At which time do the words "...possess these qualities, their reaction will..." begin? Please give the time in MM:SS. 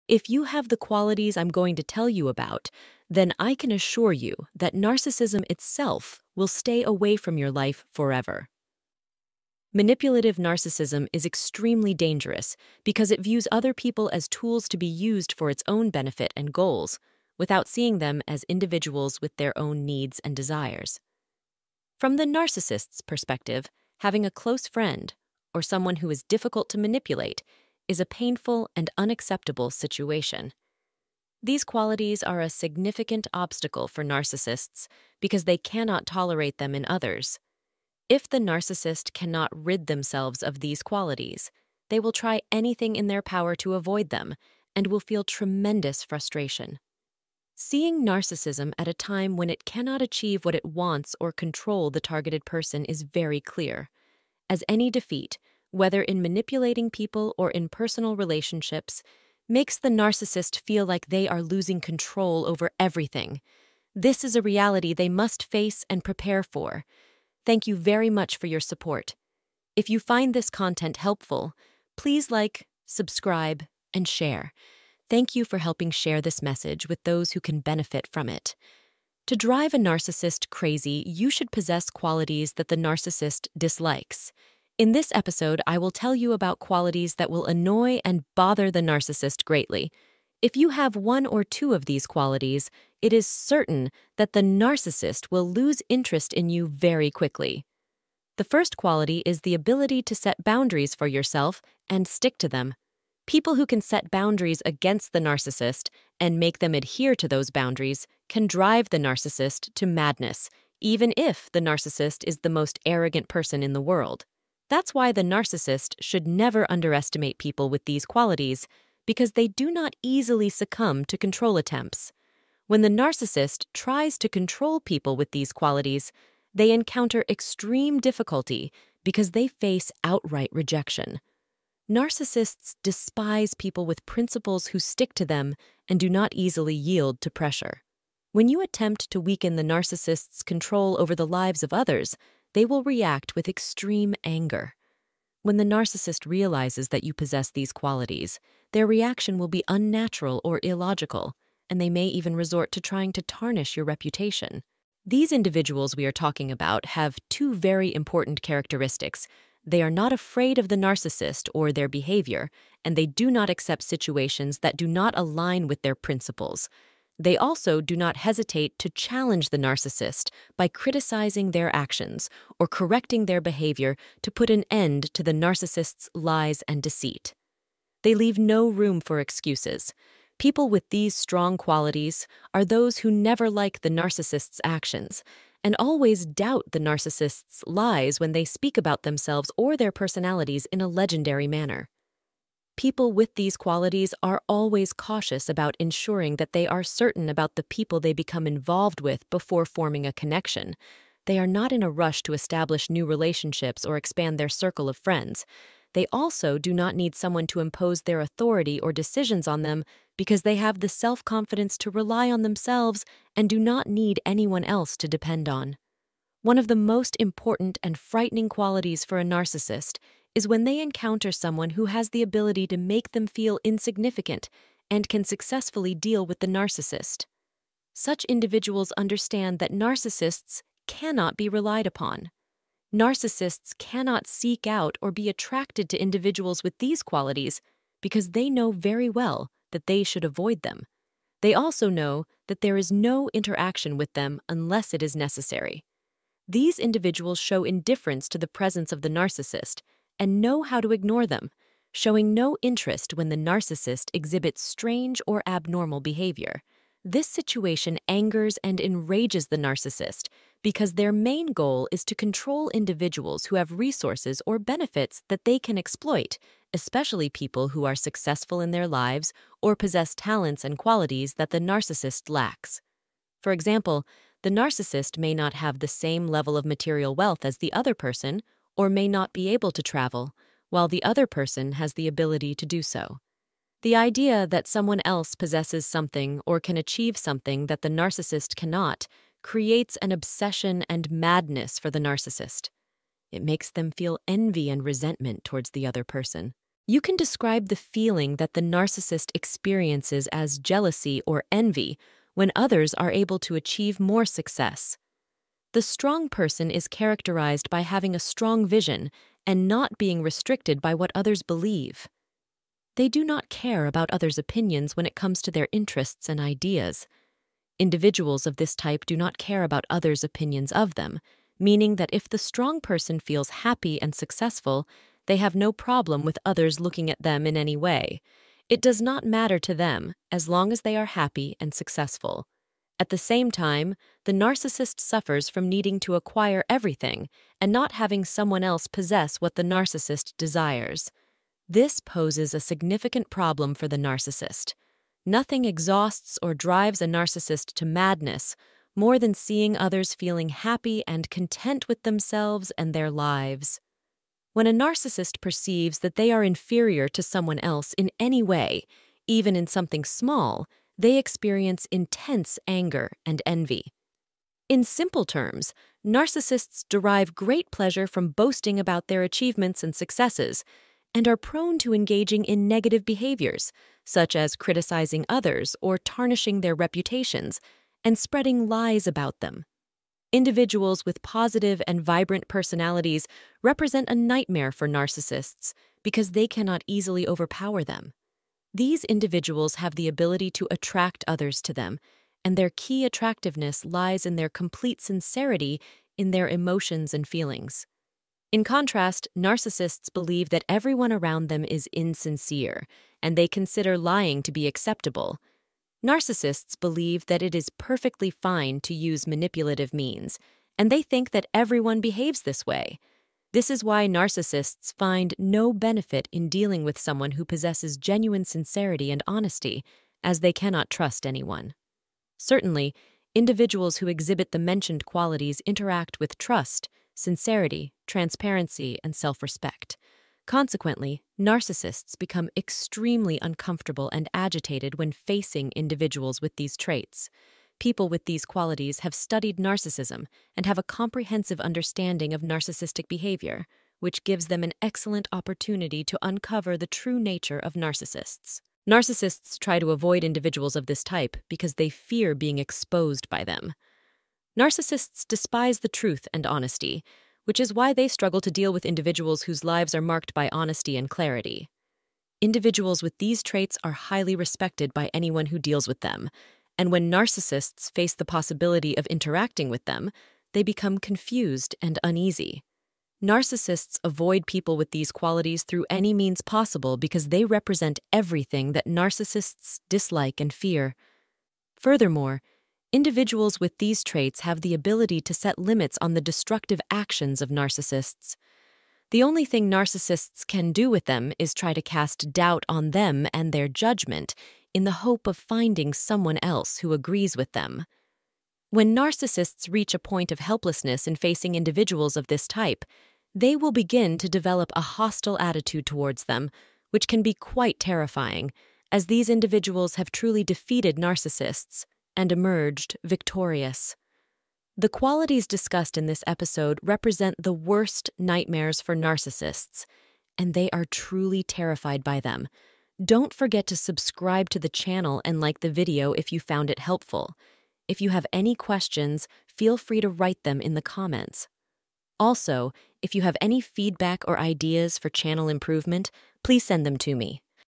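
02:27.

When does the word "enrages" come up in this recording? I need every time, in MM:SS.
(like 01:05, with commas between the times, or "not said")
04:18.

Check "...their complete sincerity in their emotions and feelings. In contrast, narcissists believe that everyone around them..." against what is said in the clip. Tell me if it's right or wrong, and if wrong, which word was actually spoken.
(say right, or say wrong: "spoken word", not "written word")
right.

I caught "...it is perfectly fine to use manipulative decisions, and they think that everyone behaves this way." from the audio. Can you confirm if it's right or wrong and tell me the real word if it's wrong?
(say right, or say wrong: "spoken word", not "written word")
wrong: "means", not "decisions".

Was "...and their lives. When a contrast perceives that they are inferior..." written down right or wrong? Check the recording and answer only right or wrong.
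wrong.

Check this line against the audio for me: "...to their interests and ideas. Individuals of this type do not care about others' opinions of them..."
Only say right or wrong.
right.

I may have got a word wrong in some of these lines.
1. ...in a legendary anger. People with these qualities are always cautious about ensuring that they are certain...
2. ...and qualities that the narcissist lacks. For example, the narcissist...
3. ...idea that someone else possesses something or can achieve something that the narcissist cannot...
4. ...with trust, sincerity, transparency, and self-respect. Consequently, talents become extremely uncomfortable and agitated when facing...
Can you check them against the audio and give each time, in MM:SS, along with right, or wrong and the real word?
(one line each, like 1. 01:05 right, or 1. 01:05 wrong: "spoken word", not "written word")
1. 03:10 wrong: "manner", not "anger"
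2. 04:30 right
3. 04:43 right
4. 07:06 wrong: "narcissists", not "talents".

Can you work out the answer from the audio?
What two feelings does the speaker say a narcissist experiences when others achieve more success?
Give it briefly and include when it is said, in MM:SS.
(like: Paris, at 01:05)
jealousy or envy, at 05:00.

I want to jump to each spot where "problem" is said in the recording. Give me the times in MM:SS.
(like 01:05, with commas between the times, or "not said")
05:25, 05:43.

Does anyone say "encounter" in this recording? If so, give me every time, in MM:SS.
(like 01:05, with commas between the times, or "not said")
02:06, 03:40.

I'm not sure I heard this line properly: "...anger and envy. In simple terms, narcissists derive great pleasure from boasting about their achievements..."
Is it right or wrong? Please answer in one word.
right.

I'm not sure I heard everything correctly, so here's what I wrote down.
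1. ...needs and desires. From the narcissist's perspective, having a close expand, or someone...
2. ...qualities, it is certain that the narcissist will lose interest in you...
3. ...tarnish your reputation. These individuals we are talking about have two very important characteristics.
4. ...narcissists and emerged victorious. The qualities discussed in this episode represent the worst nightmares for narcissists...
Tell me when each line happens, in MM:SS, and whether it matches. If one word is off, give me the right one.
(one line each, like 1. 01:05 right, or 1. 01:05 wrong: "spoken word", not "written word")
1. 00:19 wrong: "friend", not "expand"
2. 01:32 right
3. 02:33 right
4. 08:30 right.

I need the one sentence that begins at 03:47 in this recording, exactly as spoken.
Such individuals understand that narcissists cannot be relied upon.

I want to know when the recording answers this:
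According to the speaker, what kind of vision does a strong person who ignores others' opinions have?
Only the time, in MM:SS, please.
05:08.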